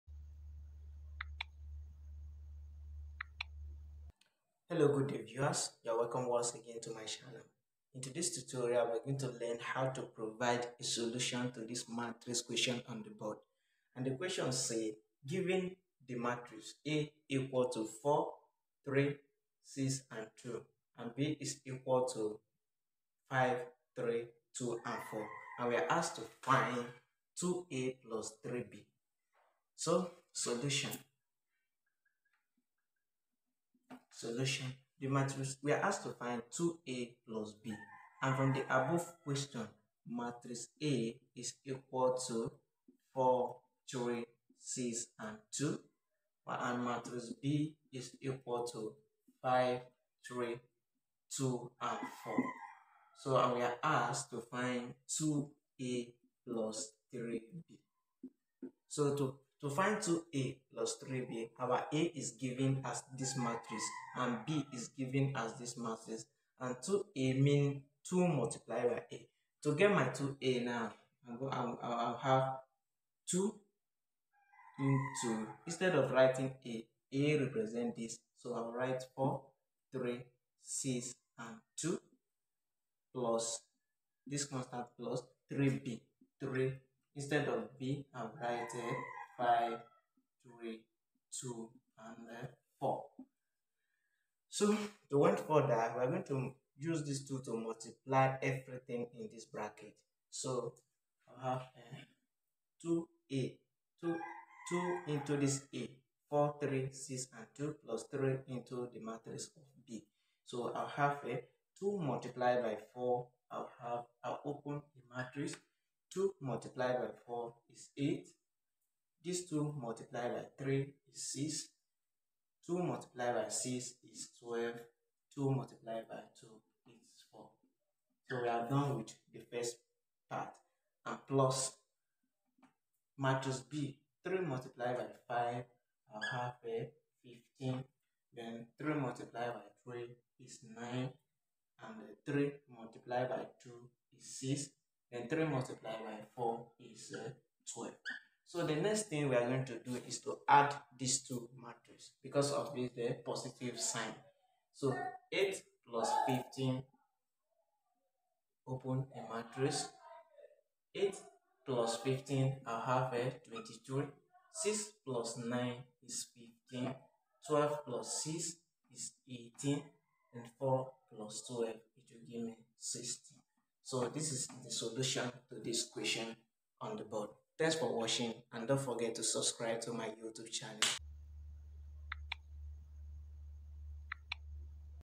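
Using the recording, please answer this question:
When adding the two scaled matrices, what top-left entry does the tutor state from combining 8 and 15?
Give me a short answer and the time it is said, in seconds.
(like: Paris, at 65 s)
22, at 163 s.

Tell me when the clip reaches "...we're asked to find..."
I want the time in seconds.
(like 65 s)
25 s.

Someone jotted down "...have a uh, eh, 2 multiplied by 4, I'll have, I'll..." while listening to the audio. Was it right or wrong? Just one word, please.
right.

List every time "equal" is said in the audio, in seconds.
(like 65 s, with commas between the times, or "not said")
17 s, 21 s, 41 s, 48 s.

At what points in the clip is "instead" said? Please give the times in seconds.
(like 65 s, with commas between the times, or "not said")
75 s, 87 s.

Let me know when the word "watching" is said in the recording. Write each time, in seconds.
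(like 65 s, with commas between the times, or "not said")
177 s.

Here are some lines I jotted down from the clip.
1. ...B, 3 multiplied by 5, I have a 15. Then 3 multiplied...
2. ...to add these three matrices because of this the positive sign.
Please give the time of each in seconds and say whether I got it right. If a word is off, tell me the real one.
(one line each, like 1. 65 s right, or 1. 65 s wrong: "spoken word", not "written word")
1. 133 s right
2. 150 s wrong: "two", not "three".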